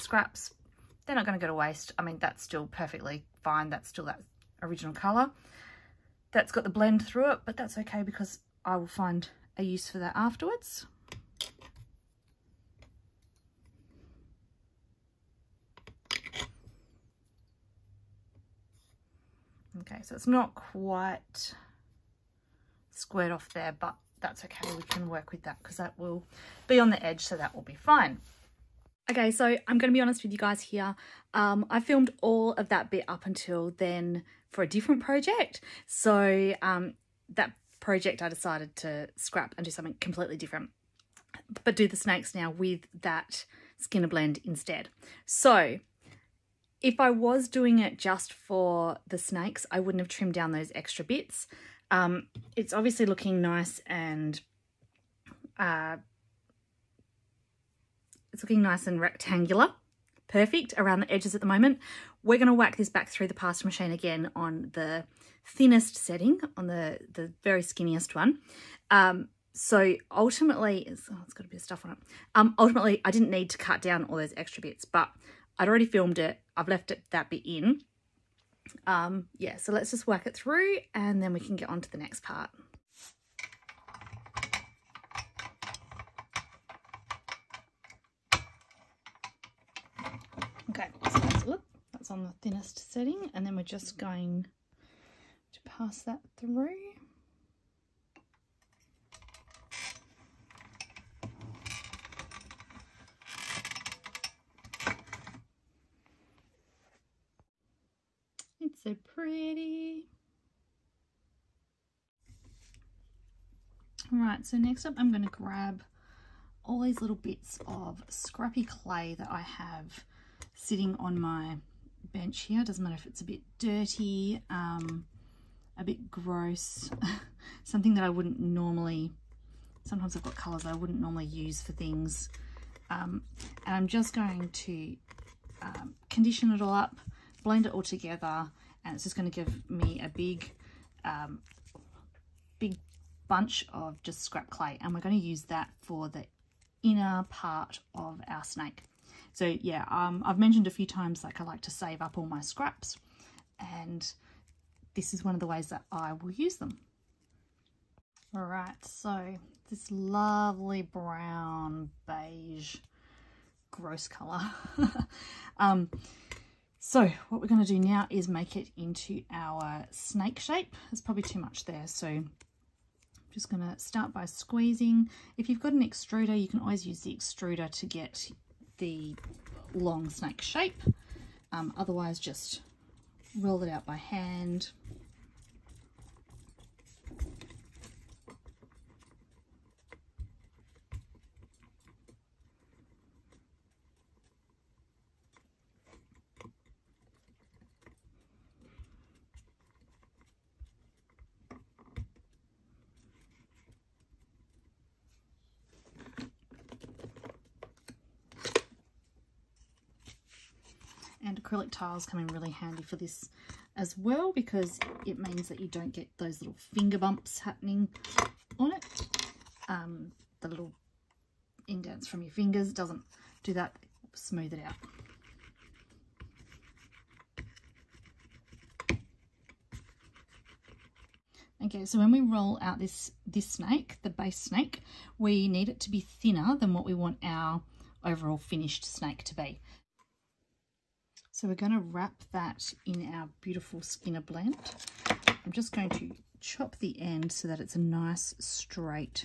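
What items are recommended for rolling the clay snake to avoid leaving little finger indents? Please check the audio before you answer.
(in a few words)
Acrylic tiles.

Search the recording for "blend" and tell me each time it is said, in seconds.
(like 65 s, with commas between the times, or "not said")
6 s, 44 s, 137 s, 244 s.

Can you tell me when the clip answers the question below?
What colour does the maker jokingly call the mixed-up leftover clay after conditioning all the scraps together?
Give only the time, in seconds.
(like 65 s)
160 s.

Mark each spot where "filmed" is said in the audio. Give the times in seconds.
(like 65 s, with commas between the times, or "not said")
31 s, 75 s.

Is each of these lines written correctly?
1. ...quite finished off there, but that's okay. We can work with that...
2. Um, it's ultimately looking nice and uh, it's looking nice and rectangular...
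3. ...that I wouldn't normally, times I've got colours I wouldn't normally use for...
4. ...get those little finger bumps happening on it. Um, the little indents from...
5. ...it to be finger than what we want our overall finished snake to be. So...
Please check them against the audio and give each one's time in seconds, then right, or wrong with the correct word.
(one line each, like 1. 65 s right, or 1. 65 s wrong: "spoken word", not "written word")
1. 20 s wrong: "squared", not "finished"
2. 51 s wrong: "obviously", not "ultimately"
3. 127 s wrong: "sometimes", not "times"
4. 215 s right
5. 235 s wrong: "thinner", not "finger".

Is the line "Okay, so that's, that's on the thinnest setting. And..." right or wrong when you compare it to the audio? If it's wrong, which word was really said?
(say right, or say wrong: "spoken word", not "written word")
right.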